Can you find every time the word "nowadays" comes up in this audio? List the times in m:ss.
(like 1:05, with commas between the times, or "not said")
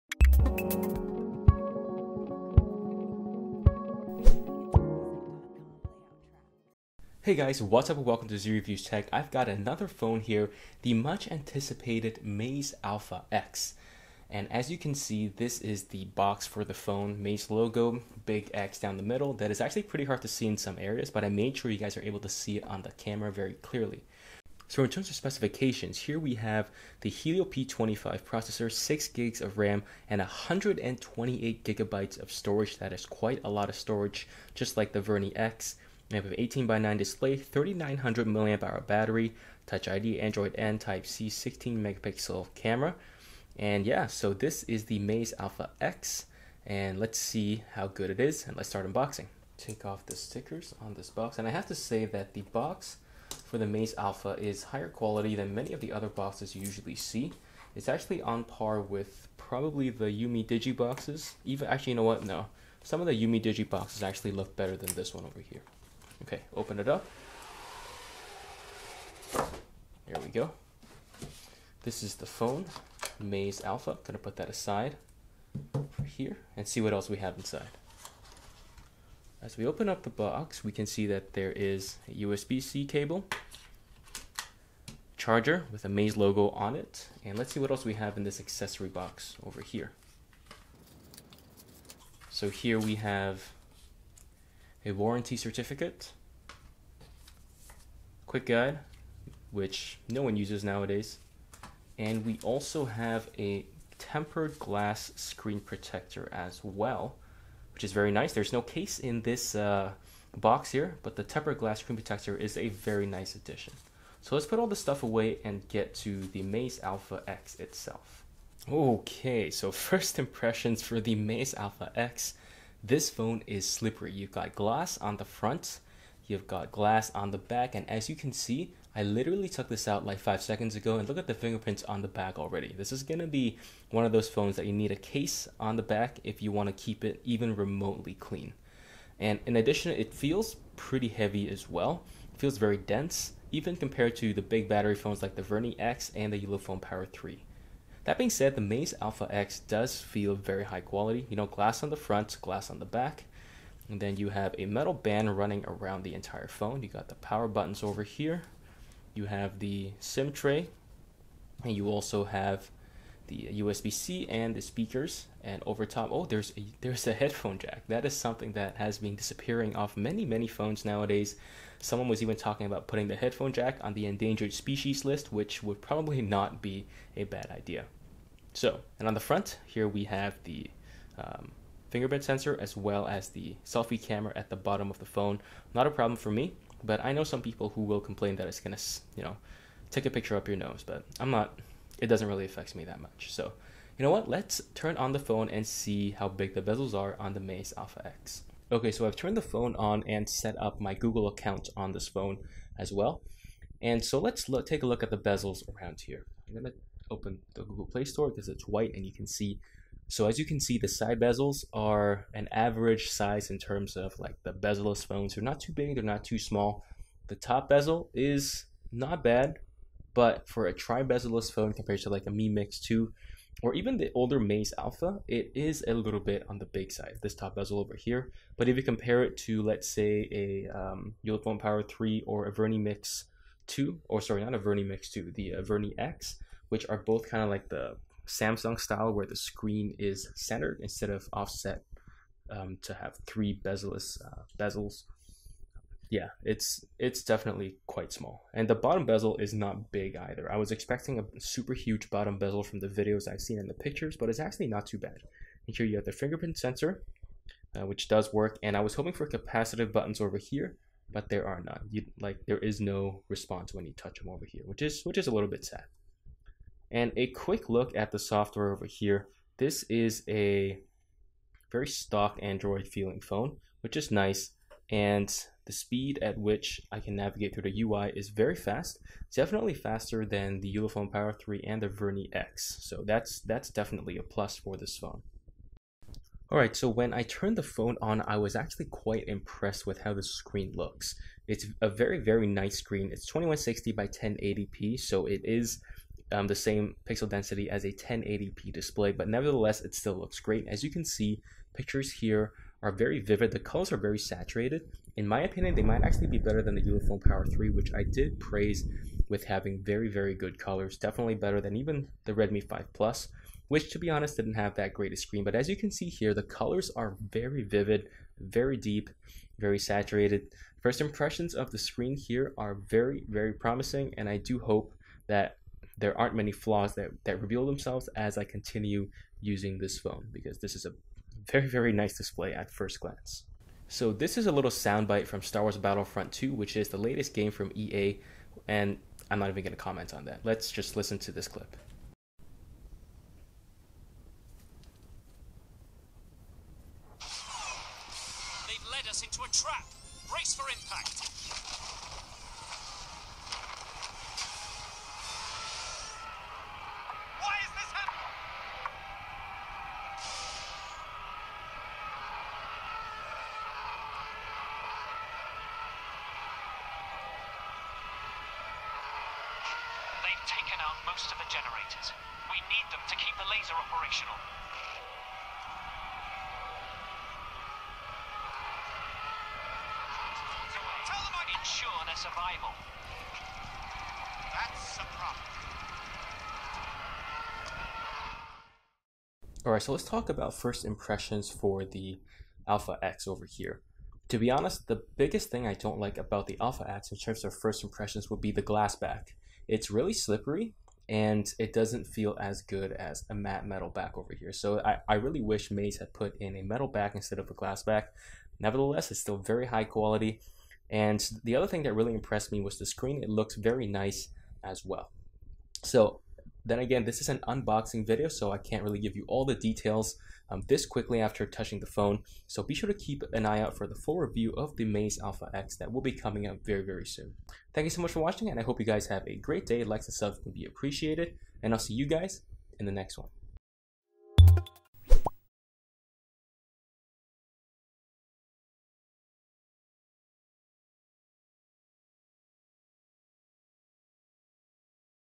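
1:40, 2:50.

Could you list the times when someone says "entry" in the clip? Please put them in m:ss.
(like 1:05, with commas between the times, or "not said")
not said.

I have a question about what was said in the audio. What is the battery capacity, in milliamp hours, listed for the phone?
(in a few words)
3900.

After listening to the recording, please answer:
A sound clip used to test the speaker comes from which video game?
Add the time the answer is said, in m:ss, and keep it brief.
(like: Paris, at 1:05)
Star Wars Battlefront 2, at 5:35.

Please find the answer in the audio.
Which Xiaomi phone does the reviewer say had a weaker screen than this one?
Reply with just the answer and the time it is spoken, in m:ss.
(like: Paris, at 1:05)
Redmi 5 Plus, at 5:12.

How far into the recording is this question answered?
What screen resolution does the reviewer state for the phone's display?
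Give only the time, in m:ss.
4:53.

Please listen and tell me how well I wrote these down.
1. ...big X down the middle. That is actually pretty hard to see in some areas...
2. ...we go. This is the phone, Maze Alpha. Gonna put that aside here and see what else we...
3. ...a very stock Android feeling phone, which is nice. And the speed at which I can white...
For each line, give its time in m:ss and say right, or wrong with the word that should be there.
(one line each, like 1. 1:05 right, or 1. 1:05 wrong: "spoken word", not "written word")
1. 0:18 right
2. 1:10 right
3. 4:30 wrong: "navigate", not "white".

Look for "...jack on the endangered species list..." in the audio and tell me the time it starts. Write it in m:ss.
2:53.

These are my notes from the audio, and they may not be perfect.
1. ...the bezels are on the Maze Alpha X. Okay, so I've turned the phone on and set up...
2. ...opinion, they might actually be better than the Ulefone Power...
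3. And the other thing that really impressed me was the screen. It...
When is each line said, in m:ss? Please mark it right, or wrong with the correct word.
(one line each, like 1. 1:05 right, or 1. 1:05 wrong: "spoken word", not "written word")
1. 3:16 right
2. 5:05 right
3. 6:50 right.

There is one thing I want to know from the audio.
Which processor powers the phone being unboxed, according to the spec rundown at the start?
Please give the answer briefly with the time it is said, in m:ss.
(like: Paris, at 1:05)
Helio P25, at 0:27.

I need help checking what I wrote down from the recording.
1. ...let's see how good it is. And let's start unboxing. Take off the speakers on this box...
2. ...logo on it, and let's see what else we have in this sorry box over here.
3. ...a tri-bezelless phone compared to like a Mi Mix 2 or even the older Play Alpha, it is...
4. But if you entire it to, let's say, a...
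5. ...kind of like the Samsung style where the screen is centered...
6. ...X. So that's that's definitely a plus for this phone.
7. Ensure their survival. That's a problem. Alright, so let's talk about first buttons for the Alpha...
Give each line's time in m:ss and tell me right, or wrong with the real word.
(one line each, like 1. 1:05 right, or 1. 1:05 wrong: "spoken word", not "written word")
1. 0:46 wrong: "stickers", not "speakers"
2. 1:26 wrong: "accessory", not "sorry"
3. 3:40 wrong: "Maze", not "Play"
4. 3:48 wrong: "compare", not "entire"
5. 3:57 right
6. 4:42 right
7. 6:21 wrong: "impressions", not "buttons".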